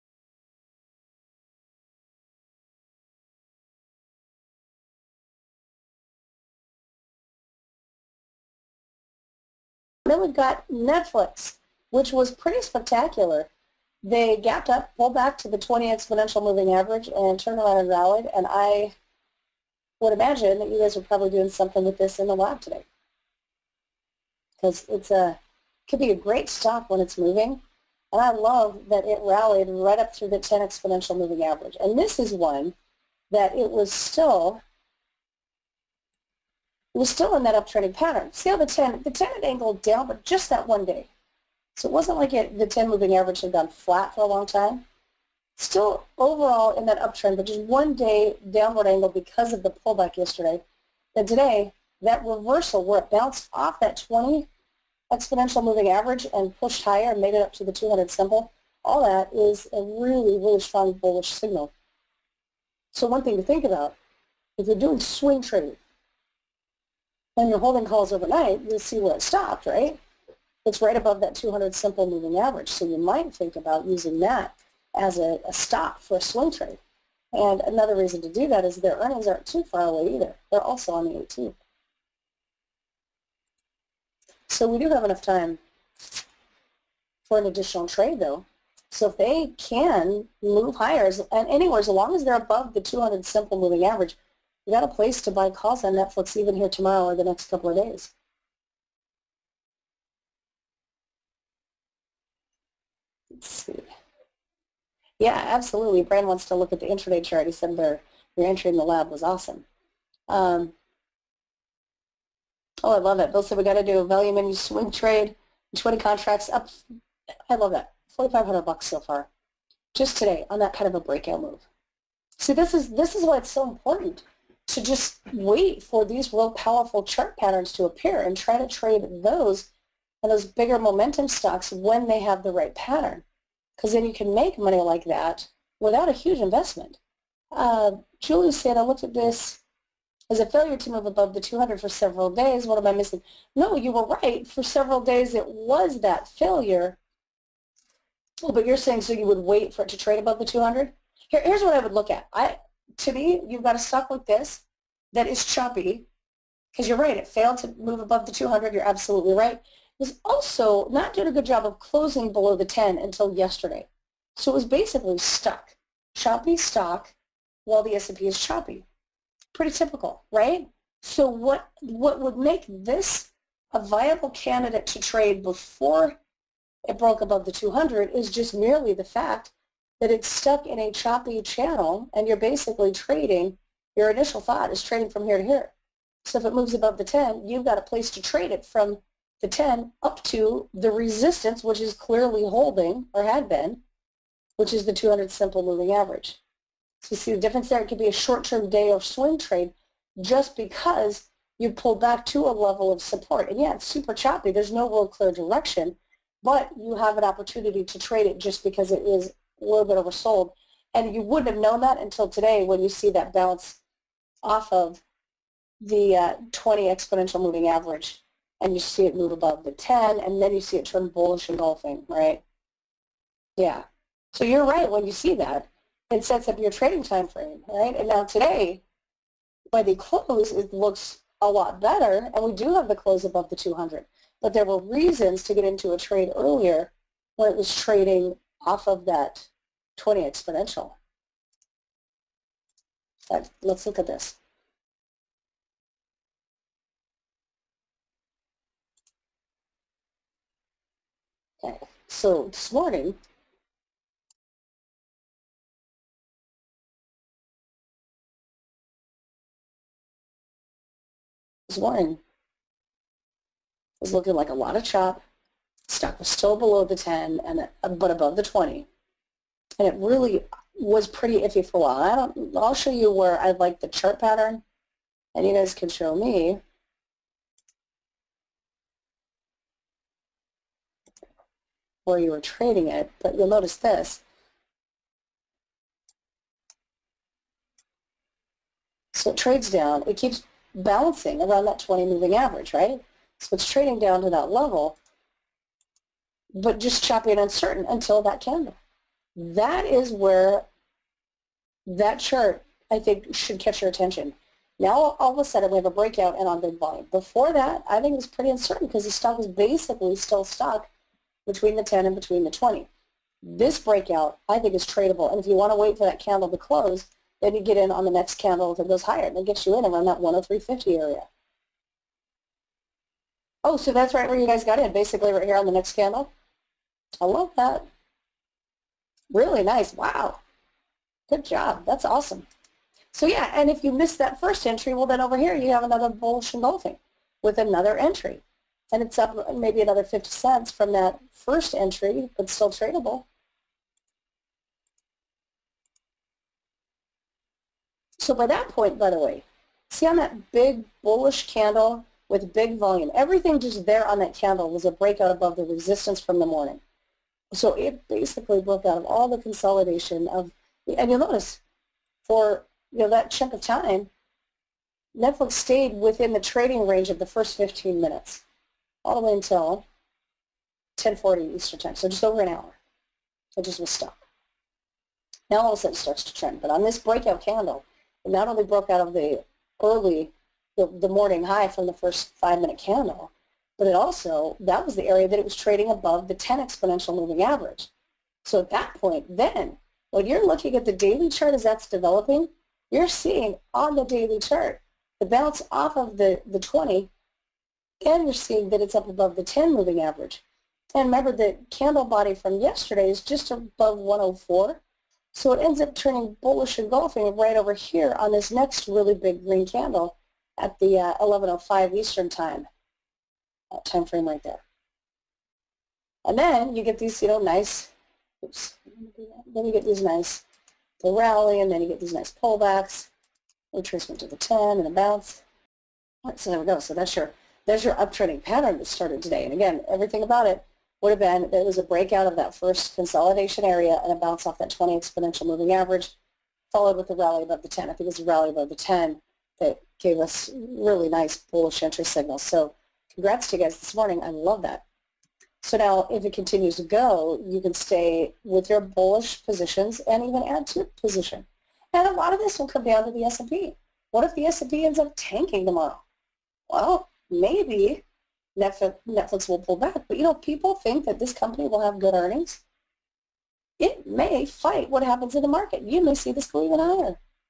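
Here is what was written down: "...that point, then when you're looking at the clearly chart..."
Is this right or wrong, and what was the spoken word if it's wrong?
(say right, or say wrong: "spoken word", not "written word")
wrong: "daily", not "clearly".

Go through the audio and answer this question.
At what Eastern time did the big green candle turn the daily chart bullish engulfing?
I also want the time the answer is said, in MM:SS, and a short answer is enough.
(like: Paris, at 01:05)
11:05, at 06:51.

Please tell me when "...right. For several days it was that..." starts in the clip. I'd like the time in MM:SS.
02:24.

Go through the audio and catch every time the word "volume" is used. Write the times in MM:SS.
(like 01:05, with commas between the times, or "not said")
05:06, 05:52.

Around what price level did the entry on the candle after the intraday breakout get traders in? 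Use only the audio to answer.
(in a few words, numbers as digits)
103.50.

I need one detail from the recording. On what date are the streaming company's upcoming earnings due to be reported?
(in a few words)
18th.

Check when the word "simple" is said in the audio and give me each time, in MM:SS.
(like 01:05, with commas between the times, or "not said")
00:58, 01:11, 01:33, 03:15.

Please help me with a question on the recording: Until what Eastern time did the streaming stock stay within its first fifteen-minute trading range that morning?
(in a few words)
10:40.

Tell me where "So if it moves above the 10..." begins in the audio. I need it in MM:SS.
03:06.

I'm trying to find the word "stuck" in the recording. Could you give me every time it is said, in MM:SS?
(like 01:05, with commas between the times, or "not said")
02:45, 03:00, 05:10, 06:13.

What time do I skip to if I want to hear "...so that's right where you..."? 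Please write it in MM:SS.
05:23.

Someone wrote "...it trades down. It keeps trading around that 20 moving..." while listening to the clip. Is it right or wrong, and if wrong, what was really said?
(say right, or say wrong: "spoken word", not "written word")
wrong: "balancing", not "trading".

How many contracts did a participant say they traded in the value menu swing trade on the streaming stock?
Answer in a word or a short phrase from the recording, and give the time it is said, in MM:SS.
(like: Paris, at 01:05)
20, at 01:55.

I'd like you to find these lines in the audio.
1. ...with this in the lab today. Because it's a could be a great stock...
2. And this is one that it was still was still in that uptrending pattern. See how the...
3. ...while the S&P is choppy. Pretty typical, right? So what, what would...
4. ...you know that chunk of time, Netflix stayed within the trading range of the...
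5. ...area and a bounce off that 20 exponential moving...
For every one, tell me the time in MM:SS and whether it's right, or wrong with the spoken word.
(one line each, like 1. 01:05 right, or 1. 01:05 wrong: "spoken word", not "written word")
1. 00:21 right
2. 00:31 right
3. 02:47 right
4. 06:02 right
5. 07:13 right.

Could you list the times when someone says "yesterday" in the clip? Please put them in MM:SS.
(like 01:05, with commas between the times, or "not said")
00:50, 02:43, 06:42.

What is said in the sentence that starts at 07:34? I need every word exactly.
What if the S&P ends up tanking tomorrow?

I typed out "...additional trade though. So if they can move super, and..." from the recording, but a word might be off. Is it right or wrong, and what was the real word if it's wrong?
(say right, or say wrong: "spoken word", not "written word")
wrong: "higher", not "super".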